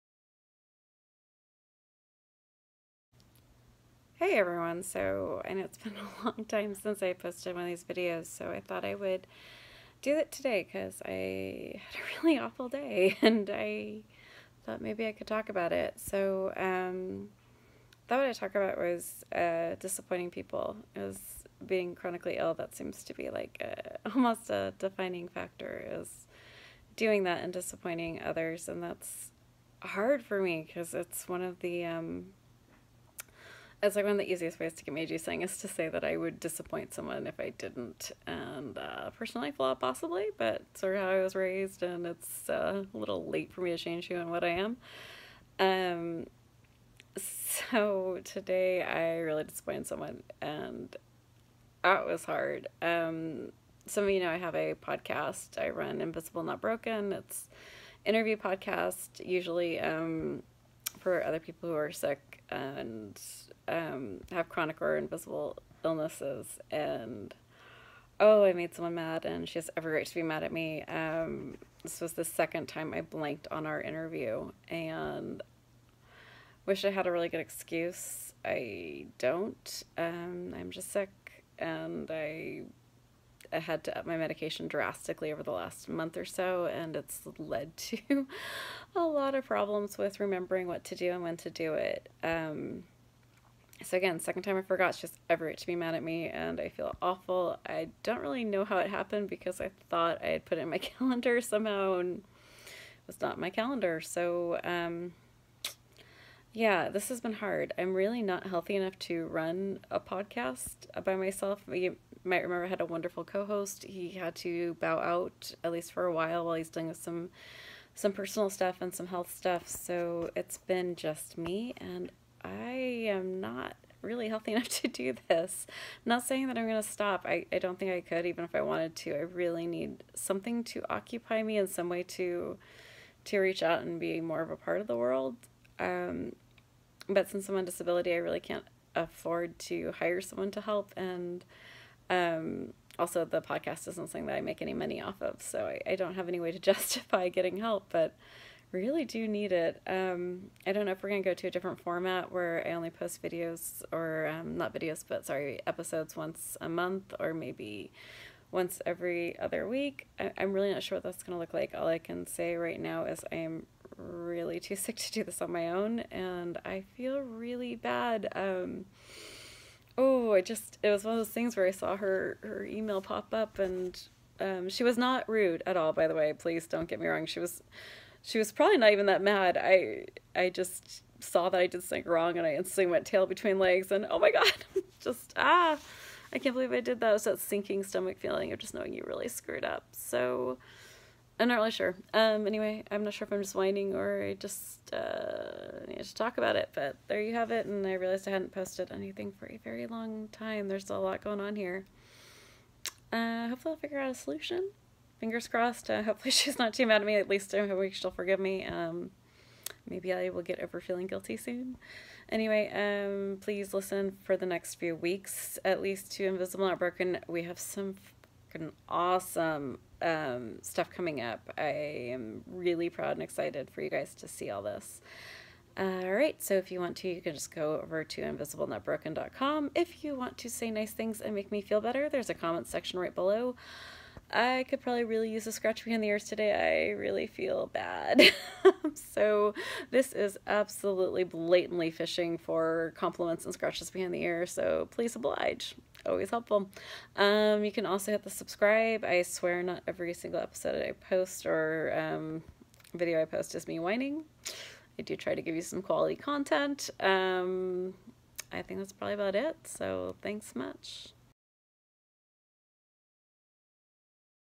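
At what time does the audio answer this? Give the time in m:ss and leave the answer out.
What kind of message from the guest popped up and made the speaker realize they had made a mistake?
2:52.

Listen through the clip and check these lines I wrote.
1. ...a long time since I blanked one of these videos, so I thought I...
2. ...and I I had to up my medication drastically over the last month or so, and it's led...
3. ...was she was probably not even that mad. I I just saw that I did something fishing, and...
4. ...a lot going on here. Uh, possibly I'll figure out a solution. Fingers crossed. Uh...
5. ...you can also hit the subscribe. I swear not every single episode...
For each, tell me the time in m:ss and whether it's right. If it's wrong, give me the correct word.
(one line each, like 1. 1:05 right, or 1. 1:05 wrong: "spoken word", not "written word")
1. 0:06 wrong: "posted", not "blanked"
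2. 1:21 right
3. 2:57 wrong: "wrong", not "fishing"
4. 3:20 wrong: "hopefully", not "possibly"
5. 4:07 right.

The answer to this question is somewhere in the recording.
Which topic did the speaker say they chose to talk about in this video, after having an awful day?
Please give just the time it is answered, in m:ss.
0:19.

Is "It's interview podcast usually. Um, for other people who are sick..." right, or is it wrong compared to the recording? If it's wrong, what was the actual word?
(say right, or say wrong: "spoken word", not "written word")
right.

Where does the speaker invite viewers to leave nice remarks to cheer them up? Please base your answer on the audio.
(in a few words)
comment section.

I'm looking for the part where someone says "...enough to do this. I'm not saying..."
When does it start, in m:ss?
2:04.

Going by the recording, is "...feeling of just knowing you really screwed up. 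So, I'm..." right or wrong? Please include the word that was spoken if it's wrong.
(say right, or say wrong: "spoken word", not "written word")
right.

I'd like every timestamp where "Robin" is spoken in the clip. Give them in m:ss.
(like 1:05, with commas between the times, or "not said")
not said.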